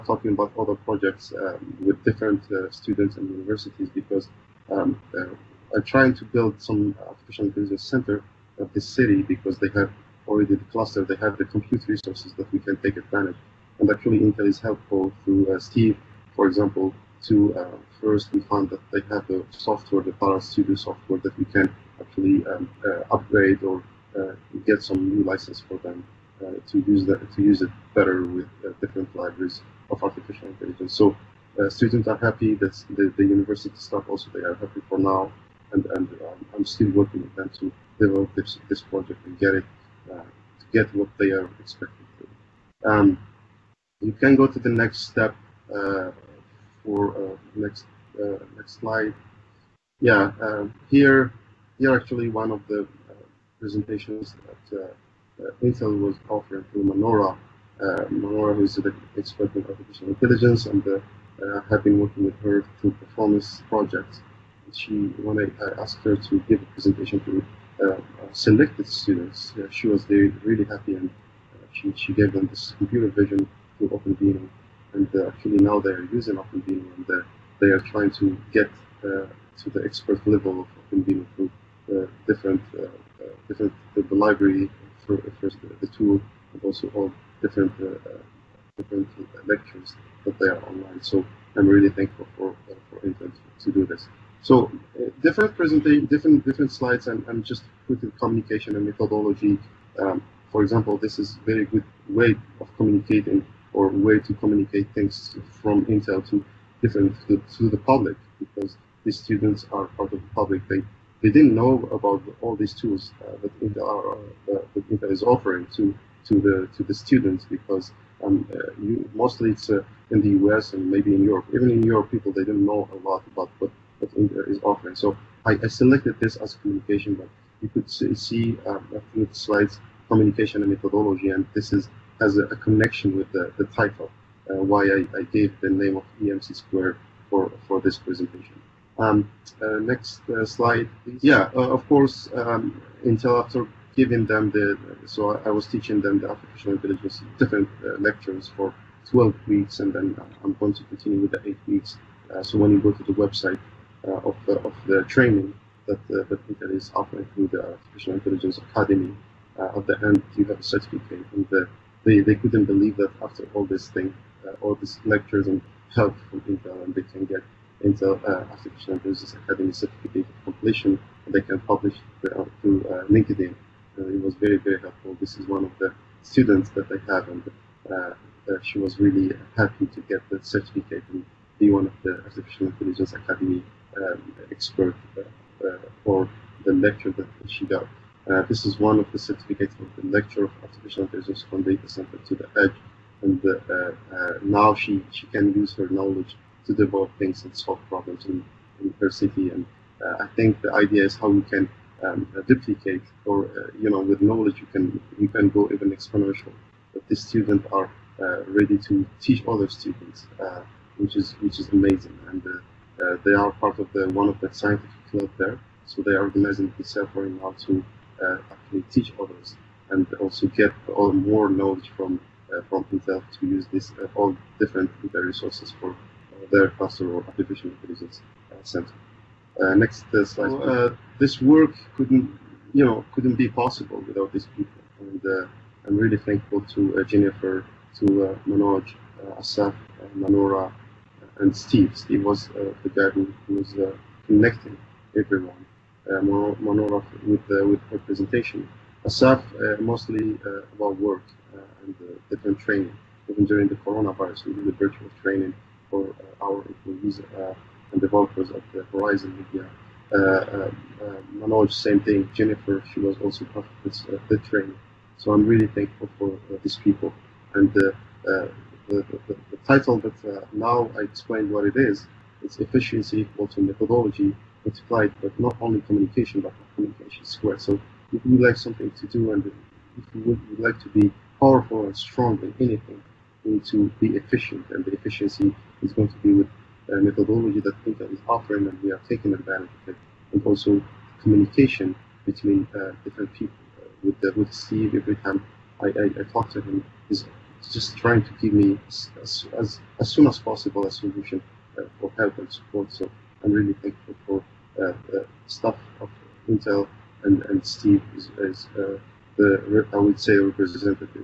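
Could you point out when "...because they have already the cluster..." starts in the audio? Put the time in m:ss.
0:09.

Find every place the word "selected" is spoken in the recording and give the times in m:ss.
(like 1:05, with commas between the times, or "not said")
1:08, 2:05.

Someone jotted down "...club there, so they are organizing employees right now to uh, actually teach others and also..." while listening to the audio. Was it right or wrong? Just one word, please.
wrong.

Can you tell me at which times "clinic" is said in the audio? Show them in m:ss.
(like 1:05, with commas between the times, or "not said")
not said.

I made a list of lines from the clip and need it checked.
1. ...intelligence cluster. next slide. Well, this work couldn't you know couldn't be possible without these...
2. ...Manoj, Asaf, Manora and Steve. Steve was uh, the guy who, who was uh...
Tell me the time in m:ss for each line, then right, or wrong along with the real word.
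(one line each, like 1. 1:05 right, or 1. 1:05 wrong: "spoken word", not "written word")
1. 3:47 wrong: "center", not "cluster"
2. 3:58 right.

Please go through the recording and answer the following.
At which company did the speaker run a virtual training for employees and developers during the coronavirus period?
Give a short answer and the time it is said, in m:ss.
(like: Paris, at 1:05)
Verizon Media, at 4:18.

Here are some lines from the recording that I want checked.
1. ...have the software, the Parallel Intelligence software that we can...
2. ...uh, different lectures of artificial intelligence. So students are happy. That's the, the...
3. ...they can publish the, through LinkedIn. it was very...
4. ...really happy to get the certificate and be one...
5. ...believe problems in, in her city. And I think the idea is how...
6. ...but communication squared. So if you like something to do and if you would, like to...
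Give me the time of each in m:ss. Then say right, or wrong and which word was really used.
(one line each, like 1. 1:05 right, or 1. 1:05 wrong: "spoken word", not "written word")
1. 0:19 wrong: "Studio", not "Intelligence"
2. 0:28 wrong: "libraries", not "lectures"
3. 2:51 right
4. 2:58 right
5. 3:17 wrong: "solve", not "believe"
6. 4:36 right.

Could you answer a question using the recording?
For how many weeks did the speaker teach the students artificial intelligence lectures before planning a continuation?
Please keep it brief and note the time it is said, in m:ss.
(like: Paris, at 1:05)
12, at 2:29.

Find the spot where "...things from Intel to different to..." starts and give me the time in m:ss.
1:44.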